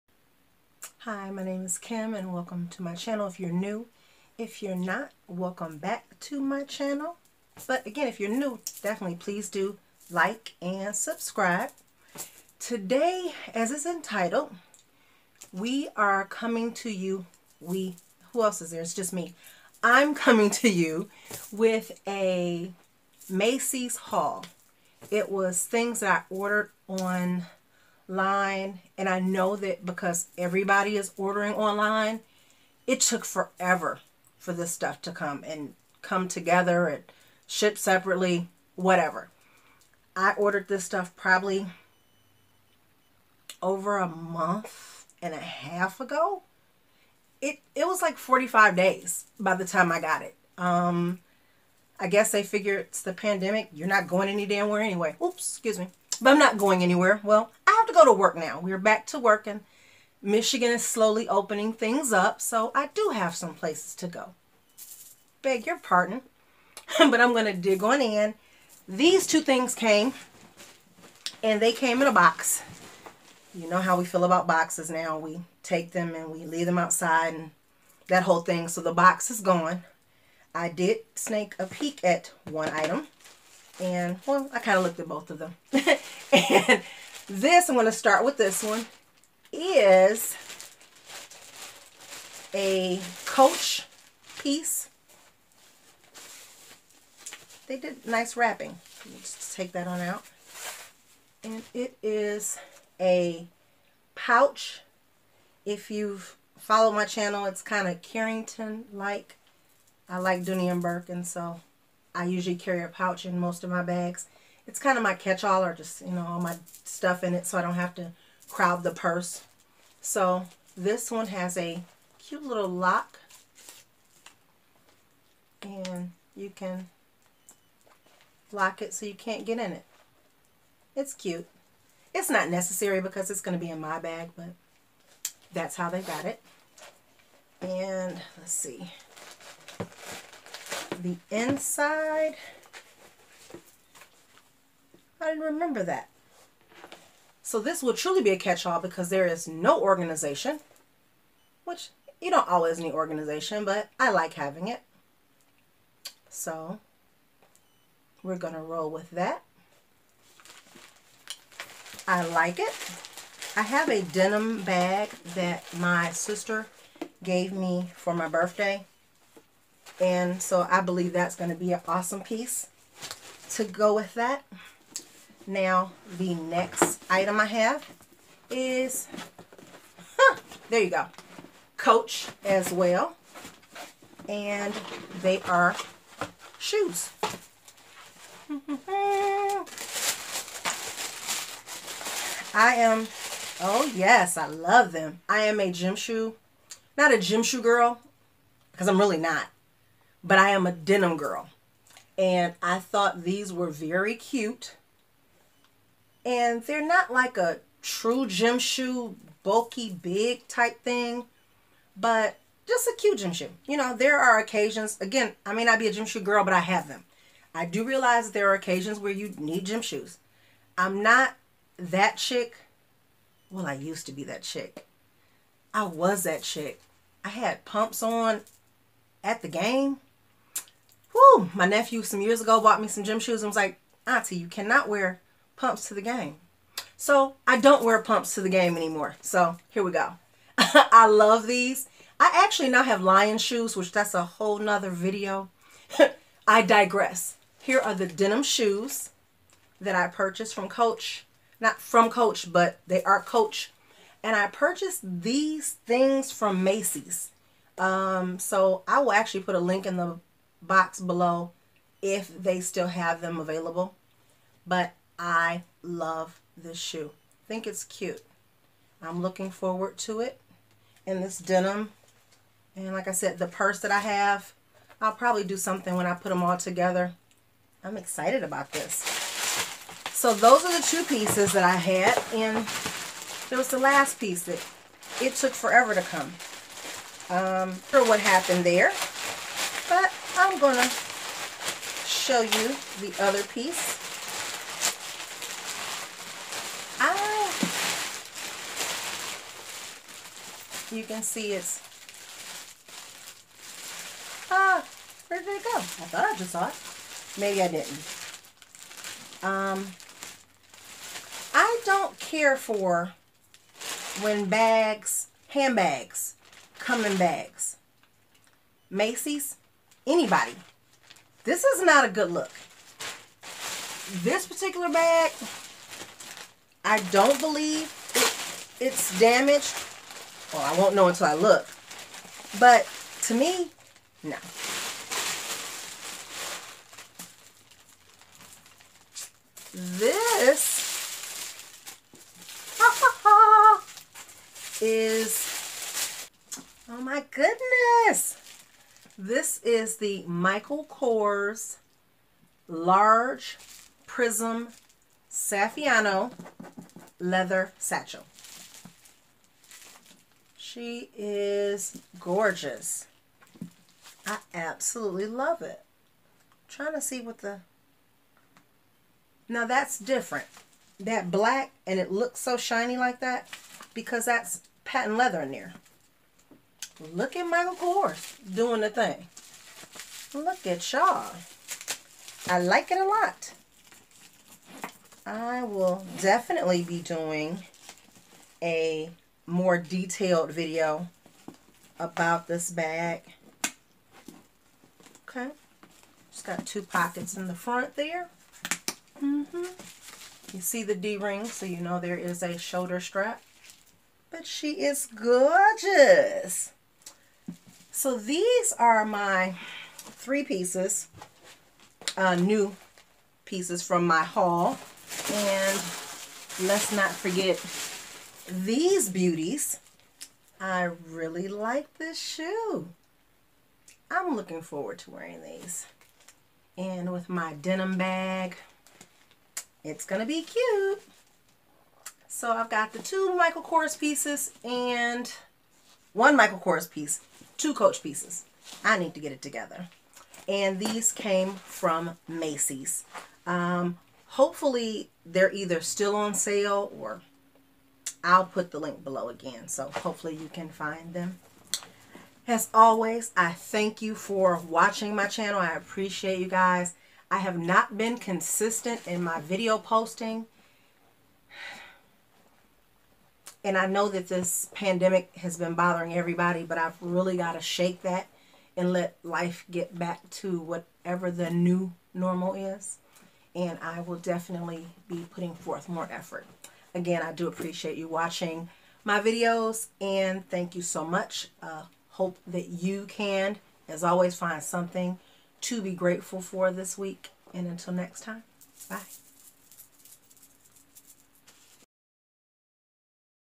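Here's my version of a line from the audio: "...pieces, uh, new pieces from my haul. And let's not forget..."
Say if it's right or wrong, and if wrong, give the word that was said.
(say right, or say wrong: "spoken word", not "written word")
right.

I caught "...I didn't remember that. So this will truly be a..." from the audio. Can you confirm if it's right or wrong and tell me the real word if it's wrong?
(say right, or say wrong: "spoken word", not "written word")
right.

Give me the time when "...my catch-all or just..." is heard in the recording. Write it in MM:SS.
01:55.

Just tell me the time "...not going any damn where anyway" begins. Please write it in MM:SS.
00:53.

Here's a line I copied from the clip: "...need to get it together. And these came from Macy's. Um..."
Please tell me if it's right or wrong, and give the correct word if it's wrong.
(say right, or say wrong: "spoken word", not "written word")
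right.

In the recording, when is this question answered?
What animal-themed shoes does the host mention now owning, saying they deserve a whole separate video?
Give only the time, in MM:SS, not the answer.
04:03.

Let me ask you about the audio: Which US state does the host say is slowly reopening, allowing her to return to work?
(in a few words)
Michigan.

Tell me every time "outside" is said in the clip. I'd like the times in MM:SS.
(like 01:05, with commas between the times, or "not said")
01:16.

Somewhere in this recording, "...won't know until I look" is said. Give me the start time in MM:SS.
05:30.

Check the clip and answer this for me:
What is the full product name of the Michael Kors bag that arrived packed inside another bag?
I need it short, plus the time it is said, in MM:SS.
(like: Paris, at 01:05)
Large Prism Saffiano Leather Satchel, at 05:52.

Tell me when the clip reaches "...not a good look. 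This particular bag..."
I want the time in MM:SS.
05:21.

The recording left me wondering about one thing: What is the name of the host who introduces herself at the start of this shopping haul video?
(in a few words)
Kim.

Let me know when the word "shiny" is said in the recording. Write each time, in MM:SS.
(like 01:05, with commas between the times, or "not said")
06:12.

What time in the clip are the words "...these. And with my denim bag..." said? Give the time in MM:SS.
07:05.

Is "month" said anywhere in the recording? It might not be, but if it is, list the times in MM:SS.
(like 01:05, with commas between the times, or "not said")
00:44.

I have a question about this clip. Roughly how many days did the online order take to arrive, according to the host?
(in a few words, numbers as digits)
45.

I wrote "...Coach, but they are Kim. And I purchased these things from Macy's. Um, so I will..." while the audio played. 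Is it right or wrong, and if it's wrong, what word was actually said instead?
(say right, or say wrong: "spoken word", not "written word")
wrong: "Coach", not "Kim".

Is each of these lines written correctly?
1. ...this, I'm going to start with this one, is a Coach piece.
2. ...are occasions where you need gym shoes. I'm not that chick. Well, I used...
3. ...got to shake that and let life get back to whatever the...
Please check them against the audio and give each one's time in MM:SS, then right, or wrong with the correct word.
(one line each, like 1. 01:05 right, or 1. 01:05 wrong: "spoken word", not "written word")
1. 01:27 right
2. 03:38 right
3. 07:47 right.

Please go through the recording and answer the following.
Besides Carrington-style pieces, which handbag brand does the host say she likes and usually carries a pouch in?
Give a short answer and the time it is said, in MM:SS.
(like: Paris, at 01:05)
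Dooney and Bourke, at 01:50.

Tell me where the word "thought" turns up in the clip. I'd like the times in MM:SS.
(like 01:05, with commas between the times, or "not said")
03:22, 05:06.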